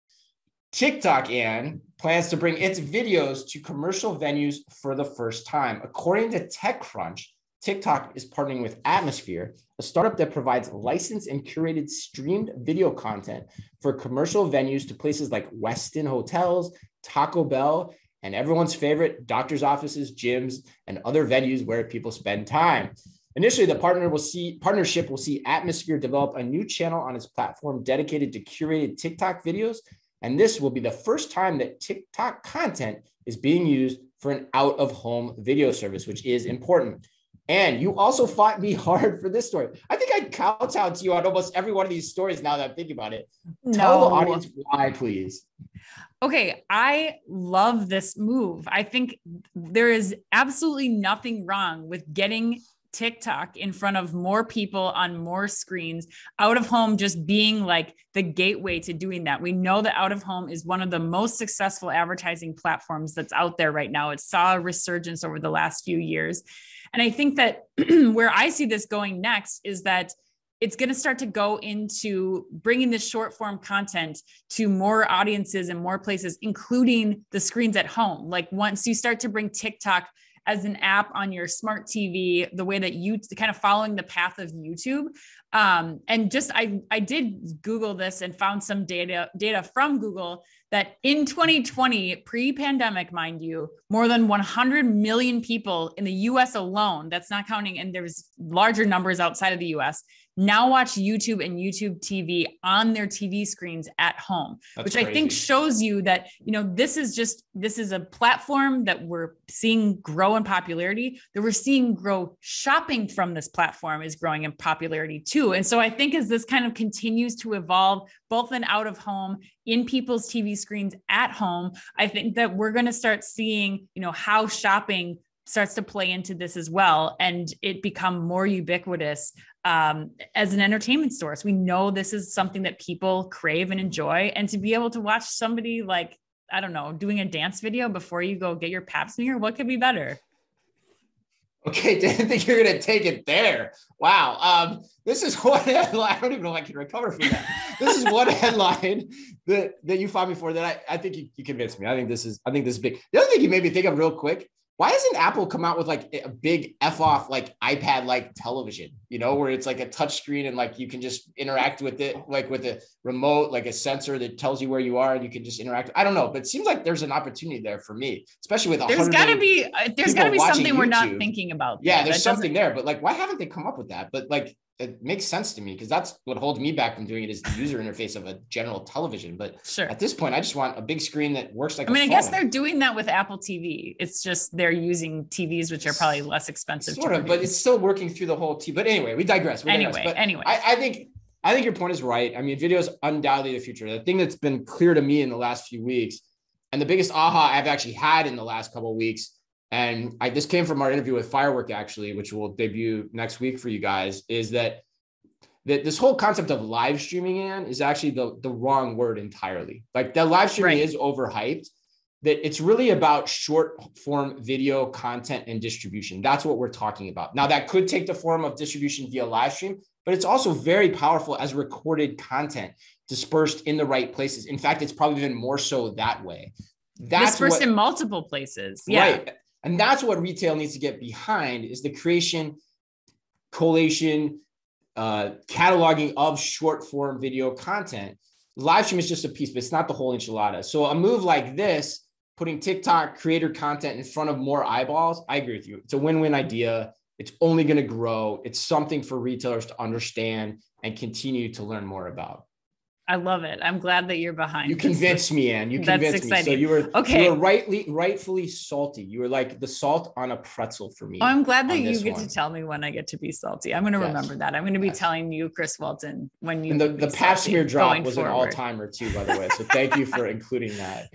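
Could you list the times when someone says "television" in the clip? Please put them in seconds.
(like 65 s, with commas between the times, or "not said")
158 s, 178 s.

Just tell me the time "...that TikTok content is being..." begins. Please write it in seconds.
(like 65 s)
31 s.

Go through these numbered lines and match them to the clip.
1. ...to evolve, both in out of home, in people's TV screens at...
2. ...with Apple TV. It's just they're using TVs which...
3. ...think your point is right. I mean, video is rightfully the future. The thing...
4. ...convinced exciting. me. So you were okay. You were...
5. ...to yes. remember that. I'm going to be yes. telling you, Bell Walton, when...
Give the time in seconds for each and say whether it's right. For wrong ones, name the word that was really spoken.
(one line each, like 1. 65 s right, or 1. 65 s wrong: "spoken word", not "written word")
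1. 117 s right
2. 182 s right
3. 191 s wrong: "undoubtedly", not "rightfully"
4. 255 s right
5. 263 s wrong: "Chris", not "Bell".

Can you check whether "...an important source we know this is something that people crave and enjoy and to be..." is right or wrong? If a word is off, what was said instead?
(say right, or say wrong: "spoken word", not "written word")
wrong: "entertainment", not "important".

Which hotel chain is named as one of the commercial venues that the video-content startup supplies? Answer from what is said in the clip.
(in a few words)
Westin Hotels.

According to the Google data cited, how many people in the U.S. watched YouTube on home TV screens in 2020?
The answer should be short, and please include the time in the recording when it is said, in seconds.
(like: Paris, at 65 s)
More than 100 million, at 93 s.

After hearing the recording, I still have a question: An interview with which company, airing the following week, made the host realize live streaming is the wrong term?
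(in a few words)
Firework.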